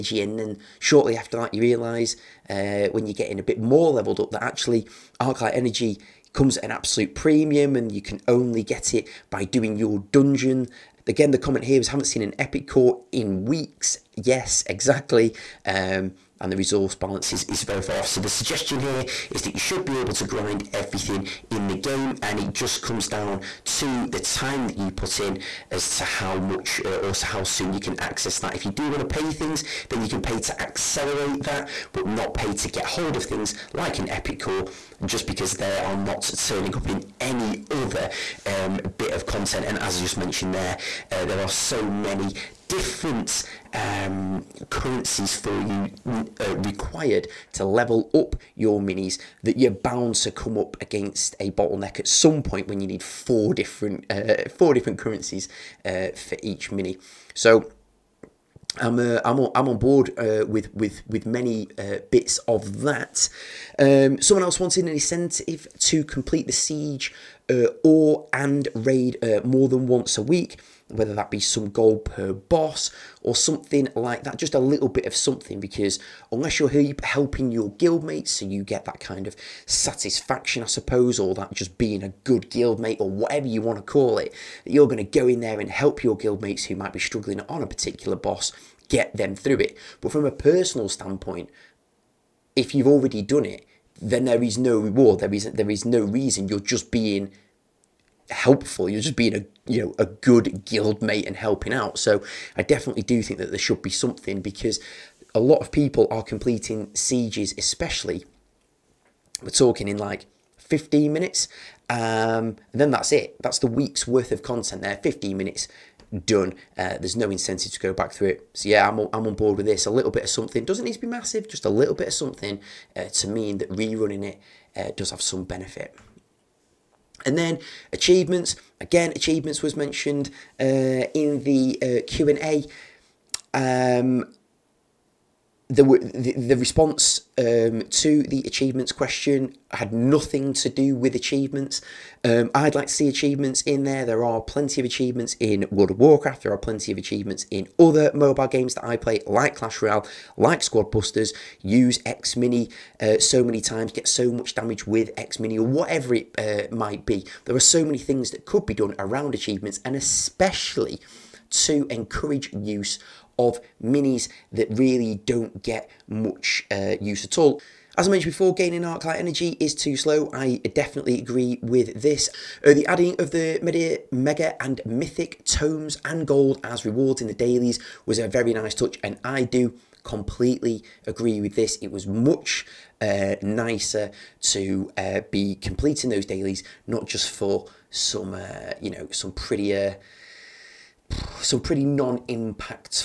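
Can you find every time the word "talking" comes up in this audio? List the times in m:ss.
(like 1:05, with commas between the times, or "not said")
1:49.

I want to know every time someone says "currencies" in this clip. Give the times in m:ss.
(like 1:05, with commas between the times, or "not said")
0:44, 0:54.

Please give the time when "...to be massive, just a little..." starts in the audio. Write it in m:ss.
2:00.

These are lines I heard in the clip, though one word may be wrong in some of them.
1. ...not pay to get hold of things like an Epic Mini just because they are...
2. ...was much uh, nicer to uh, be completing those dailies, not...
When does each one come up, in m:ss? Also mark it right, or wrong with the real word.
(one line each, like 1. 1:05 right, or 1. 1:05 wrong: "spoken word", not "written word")
1. 0:32 wrong: "Core", not "Mini"
2. 3:01 right.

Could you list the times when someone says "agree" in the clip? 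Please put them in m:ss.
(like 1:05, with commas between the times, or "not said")
2:51, 3:01.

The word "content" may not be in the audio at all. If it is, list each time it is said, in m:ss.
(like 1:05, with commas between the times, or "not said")
0:39, 1:54.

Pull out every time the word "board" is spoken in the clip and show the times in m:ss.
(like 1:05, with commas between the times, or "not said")
0:59, 1:59.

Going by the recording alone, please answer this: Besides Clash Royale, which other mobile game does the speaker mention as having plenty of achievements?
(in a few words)
Squad Busters.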